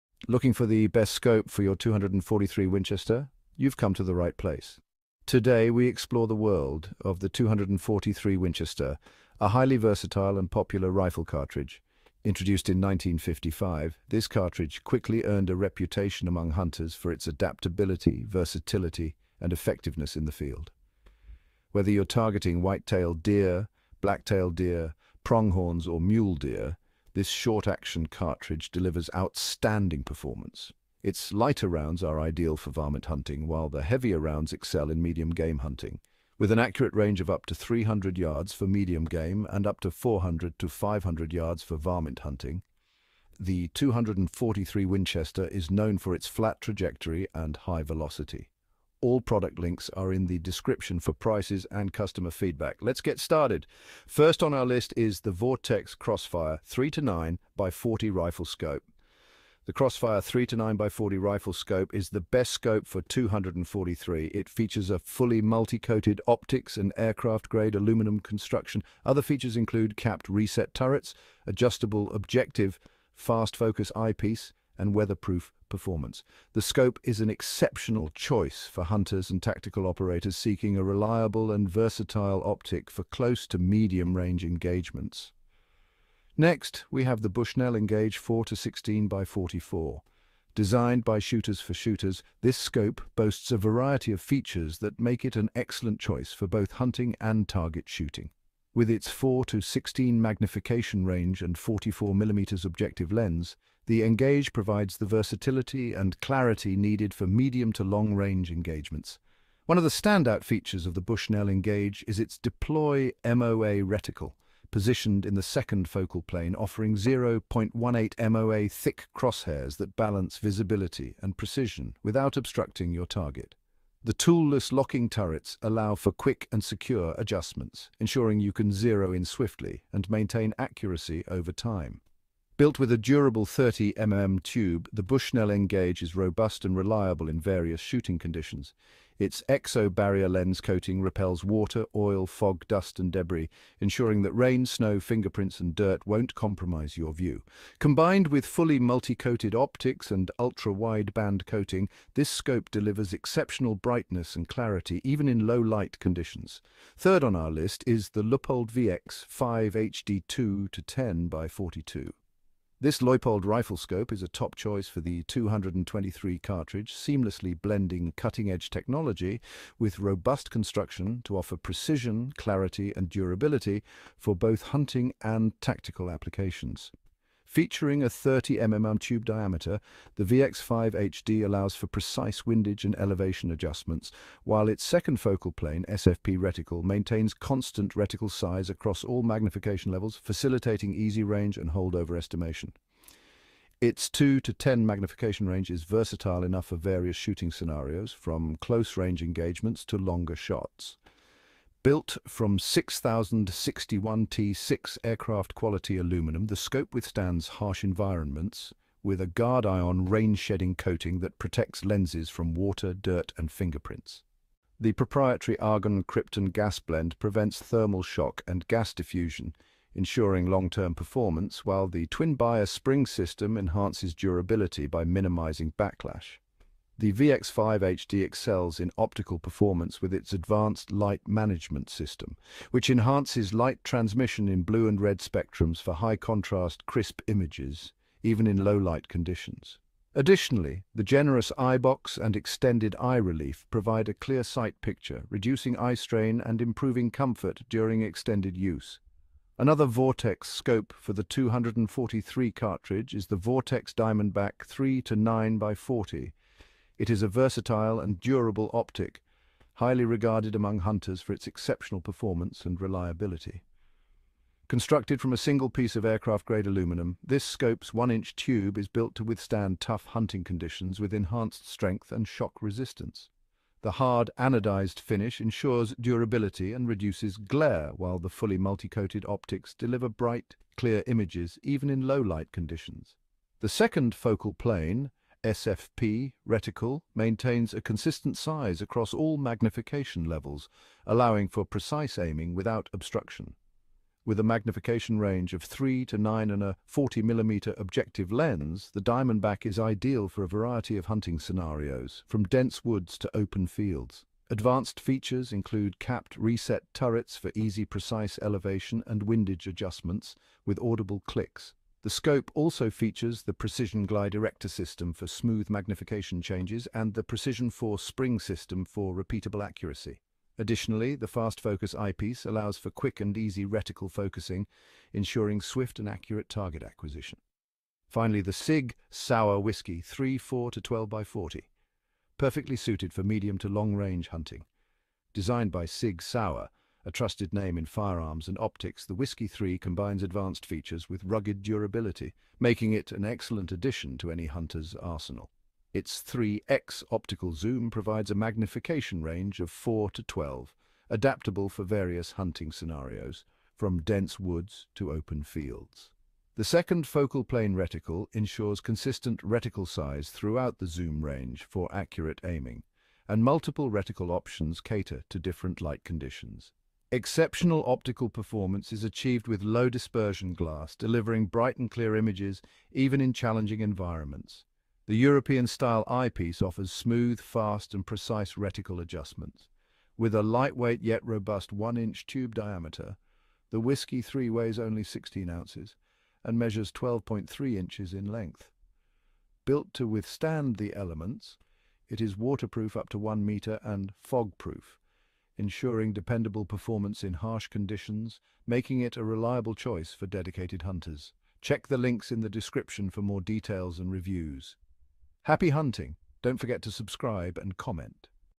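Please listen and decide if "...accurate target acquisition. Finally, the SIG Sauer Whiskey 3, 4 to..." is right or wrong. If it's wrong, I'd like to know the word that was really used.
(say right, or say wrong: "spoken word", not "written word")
right.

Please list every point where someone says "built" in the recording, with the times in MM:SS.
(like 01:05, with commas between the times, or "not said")
02:12, 03:21, 04:28, 06:29.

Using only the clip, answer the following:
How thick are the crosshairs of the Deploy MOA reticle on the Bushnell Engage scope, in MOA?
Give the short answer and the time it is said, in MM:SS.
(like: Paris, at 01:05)
0.18 MOA, at 01:56.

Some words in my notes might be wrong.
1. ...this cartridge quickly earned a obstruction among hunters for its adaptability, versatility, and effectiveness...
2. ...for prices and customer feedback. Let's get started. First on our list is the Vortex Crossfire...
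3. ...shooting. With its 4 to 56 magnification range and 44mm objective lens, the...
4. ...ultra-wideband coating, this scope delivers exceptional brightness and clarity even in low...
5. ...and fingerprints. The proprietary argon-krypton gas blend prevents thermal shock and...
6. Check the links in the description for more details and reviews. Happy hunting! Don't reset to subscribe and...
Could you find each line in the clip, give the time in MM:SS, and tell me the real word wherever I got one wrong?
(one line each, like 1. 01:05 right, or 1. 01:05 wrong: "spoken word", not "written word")
1. 00:14 wrong: "reputation", not "obstruction"
2. 00:50 right
3. 01:37 wrong: "16", not "56"
4. 02:30 right
5. 03:33 right
6. 06:41 wrong: "forget", not "reset".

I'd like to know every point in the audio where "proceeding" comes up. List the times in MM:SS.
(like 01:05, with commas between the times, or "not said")
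not said.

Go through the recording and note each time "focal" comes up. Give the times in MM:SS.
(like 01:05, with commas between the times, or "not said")
01:55, 03:05, 04:44, 05:57.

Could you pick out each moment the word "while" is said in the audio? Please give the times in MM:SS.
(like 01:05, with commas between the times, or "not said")
00:33, 03:04, 03:41, 04:37.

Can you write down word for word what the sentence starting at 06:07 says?
Exceptional optical performance is achieved with low dispersion glass, delivering bright and clear images even in challenging environments.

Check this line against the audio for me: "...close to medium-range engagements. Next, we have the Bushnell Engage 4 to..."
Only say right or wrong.
right.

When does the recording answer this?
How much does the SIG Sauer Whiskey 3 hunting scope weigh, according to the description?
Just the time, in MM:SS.
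06:25.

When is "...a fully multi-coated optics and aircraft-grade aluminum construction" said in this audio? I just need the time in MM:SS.
01:04.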